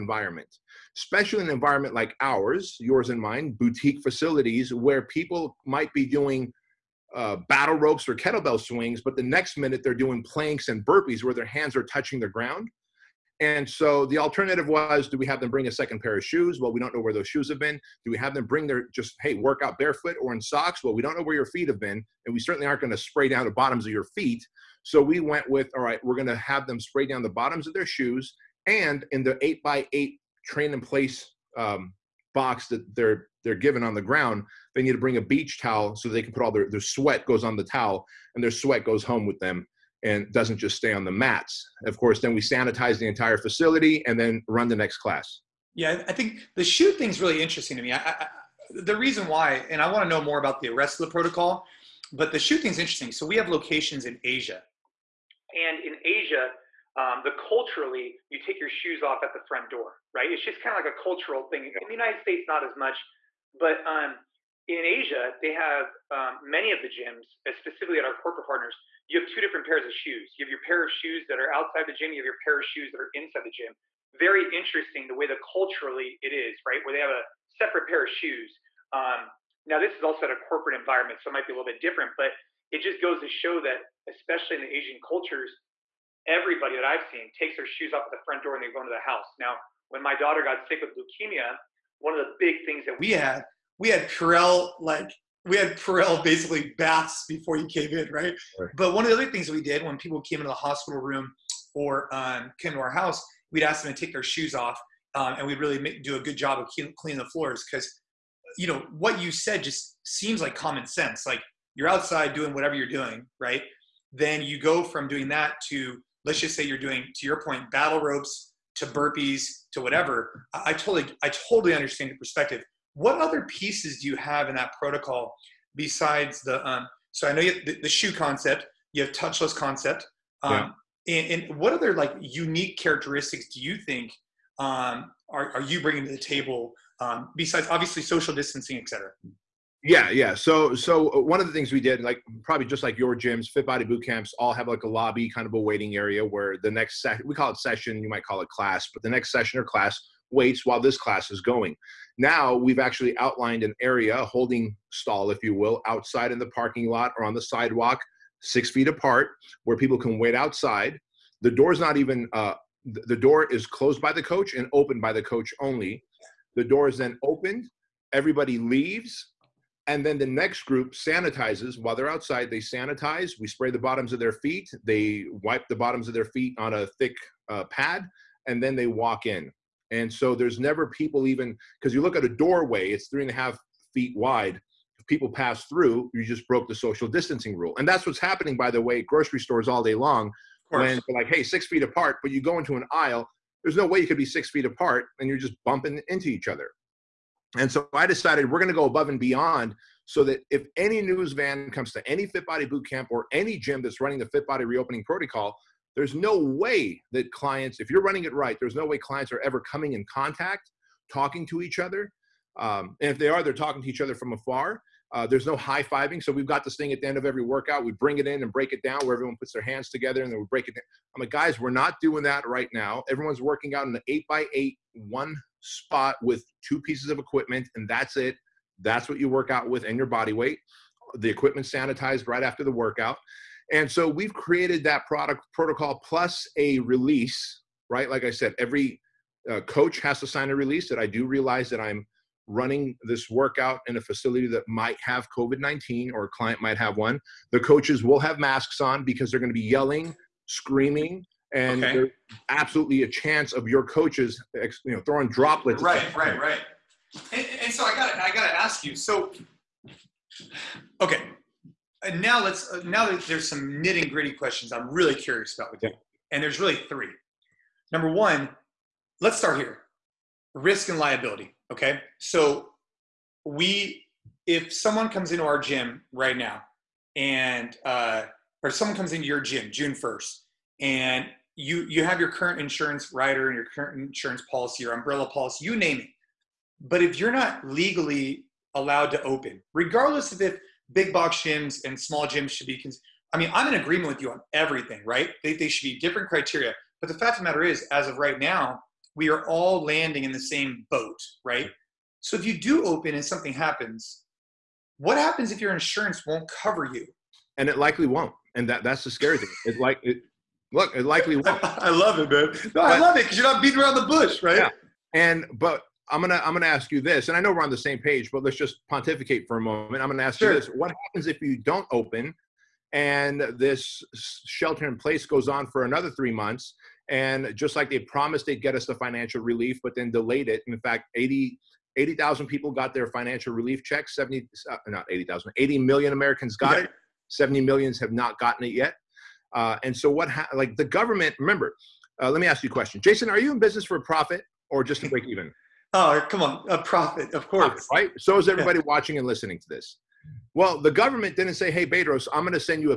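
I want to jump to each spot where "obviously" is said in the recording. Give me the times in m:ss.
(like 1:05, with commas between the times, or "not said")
2:17.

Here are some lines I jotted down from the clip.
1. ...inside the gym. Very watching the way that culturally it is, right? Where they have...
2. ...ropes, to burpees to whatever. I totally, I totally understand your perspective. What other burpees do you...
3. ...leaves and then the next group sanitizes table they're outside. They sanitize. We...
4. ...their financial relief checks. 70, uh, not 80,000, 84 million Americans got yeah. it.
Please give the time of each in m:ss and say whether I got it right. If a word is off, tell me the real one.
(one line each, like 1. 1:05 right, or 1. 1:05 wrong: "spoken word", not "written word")
1. 1:13 wrong: "interesting", not "watching"
2. 1:58 wrong: "pieces", not "burpees"
3. 2:48 wrong: "while", not "table"
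4. 5:32 wrong: "80", not "84".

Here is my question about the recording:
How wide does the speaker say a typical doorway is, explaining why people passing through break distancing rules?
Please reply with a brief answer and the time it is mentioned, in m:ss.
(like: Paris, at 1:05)
3.5 feet, at 3:03.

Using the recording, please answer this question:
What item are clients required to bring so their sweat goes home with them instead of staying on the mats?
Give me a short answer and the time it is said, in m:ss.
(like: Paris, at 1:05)
Beach towel, at 0:35.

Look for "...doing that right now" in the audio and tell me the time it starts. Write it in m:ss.
3:41.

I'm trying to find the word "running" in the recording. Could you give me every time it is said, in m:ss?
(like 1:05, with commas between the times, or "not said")
3:23, 3:28, 4:02.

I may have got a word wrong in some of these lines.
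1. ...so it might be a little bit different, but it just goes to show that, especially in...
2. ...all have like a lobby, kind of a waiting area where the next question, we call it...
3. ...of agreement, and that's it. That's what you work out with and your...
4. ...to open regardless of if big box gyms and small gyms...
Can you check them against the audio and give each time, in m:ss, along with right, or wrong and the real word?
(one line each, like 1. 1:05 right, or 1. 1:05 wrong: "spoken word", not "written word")
1. 1:21 right
2. 2:24 wrong: "session", not "question"
3. 3:47 wrong: "equipment", not "agreement"
4. 4:49 right.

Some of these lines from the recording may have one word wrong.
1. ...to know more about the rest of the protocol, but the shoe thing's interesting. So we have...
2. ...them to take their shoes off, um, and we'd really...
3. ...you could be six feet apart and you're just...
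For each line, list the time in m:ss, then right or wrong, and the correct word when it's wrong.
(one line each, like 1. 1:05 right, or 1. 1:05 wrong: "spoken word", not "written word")
1. 0:50 right
2. 1:43 right
3. 3:13 right.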